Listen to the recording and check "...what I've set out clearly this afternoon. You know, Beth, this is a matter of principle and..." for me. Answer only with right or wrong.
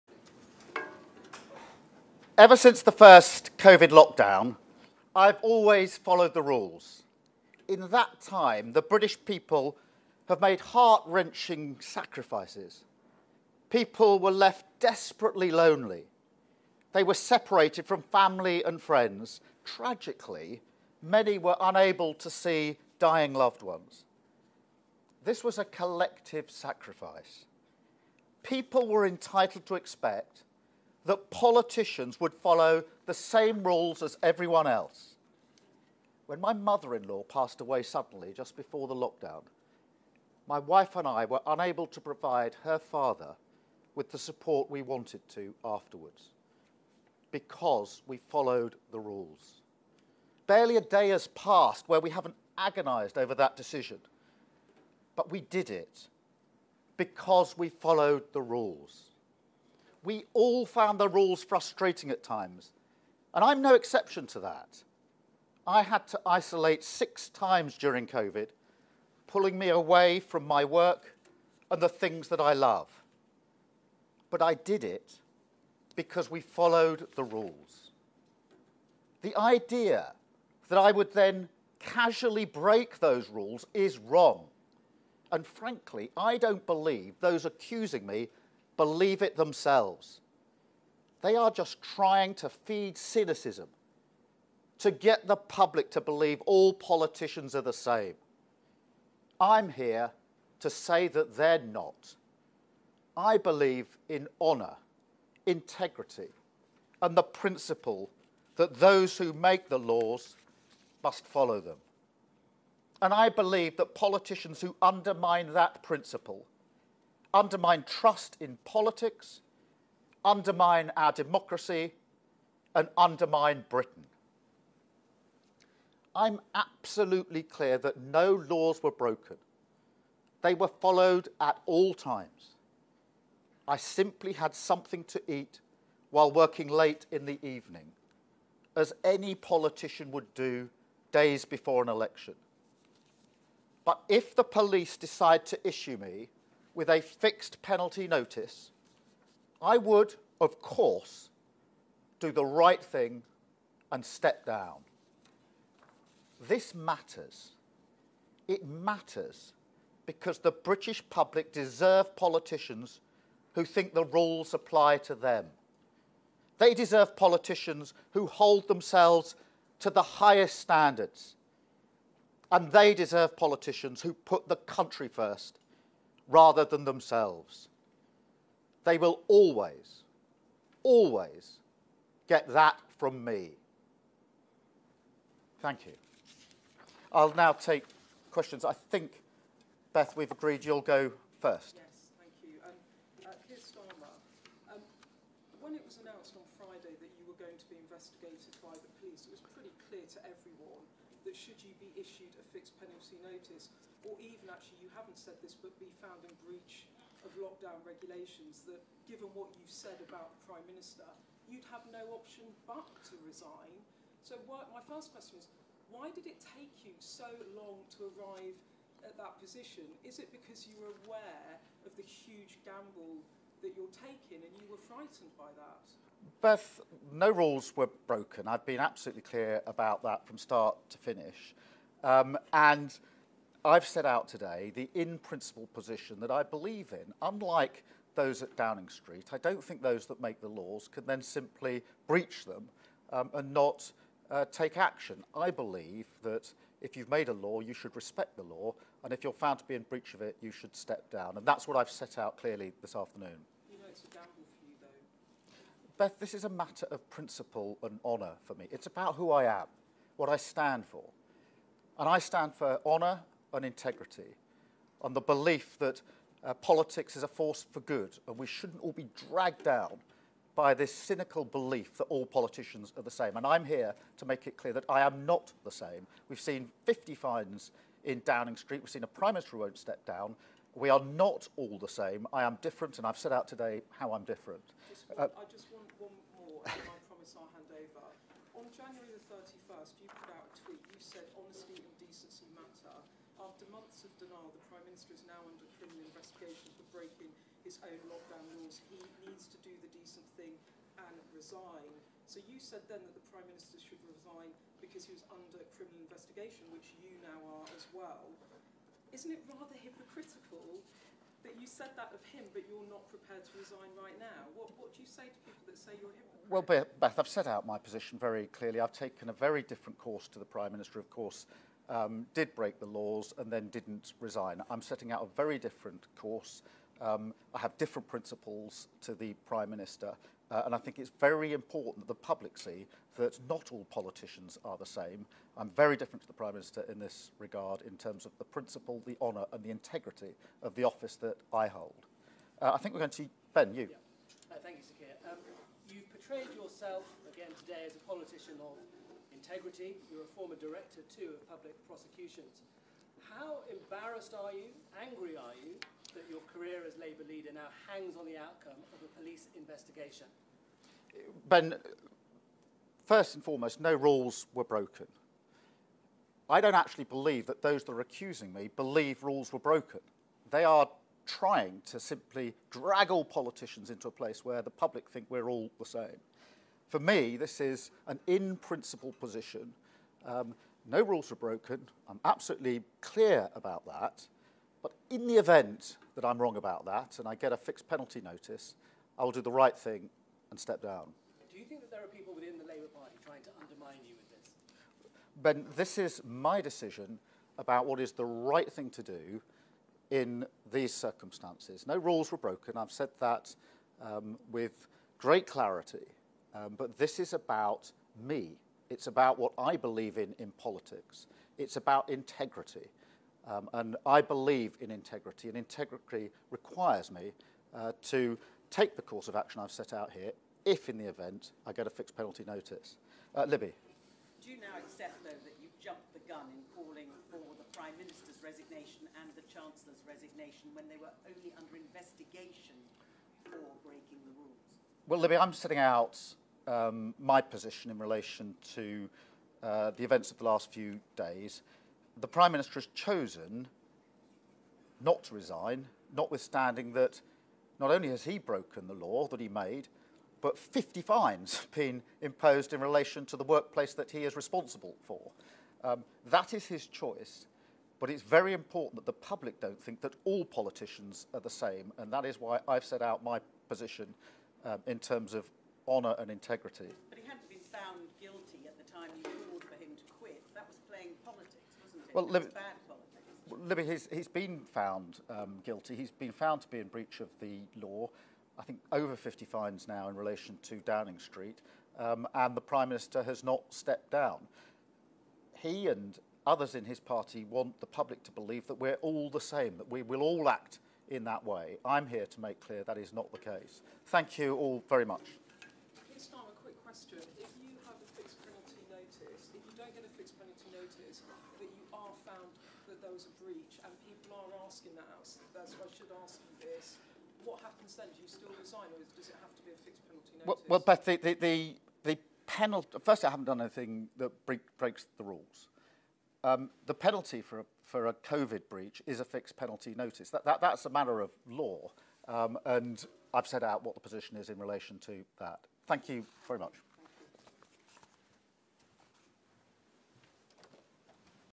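right.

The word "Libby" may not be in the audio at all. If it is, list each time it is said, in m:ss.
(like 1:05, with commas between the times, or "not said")
7:03, 7:15, 7:53.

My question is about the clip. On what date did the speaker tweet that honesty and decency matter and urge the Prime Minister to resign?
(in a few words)
January 31st.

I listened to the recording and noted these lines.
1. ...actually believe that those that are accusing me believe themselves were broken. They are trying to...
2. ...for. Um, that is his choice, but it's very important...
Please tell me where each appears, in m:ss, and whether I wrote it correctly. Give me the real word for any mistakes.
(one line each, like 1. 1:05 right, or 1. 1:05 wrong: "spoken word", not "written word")
1. 6:06 wrong: "rules", not "themselves"
2. 7:35 right.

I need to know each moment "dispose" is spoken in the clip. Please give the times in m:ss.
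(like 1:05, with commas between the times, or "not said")
not said.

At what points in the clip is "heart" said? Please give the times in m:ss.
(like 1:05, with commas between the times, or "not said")
0:10.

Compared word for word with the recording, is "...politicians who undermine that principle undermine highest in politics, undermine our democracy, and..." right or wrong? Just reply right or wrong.
wrong.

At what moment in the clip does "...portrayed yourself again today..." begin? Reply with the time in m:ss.
5:46.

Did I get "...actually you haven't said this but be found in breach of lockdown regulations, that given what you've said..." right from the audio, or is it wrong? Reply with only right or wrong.
right.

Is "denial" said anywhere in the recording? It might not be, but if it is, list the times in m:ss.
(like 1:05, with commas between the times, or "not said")
4:54.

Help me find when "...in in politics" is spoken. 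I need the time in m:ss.
6:50.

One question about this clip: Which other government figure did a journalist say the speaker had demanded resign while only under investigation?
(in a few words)
The Chancellor.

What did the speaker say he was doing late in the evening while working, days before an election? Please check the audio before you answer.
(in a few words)
Something to eat.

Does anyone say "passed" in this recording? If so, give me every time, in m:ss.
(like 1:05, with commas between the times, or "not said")
0:37, 0:51.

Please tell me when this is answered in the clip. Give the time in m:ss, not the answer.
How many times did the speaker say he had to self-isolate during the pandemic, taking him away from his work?
1:06.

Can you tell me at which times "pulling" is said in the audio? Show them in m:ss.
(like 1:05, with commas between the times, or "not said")
1:09.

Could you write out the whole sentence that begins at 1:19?
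The idea that I would then casually break those rules is wrong.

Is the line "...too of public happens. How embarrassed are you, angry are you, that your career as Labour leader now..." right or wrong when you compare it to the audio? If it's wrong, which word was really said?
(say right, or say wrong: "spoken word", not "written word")
wrong: "prosecutions", not "happens".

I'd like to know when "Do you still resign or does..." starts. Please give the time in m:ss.
8:28.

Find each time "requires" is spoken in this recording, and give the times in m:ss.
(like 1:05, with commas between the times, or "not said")
6:56.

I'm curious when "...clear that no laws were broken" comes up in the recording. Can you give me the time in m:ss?
2:07.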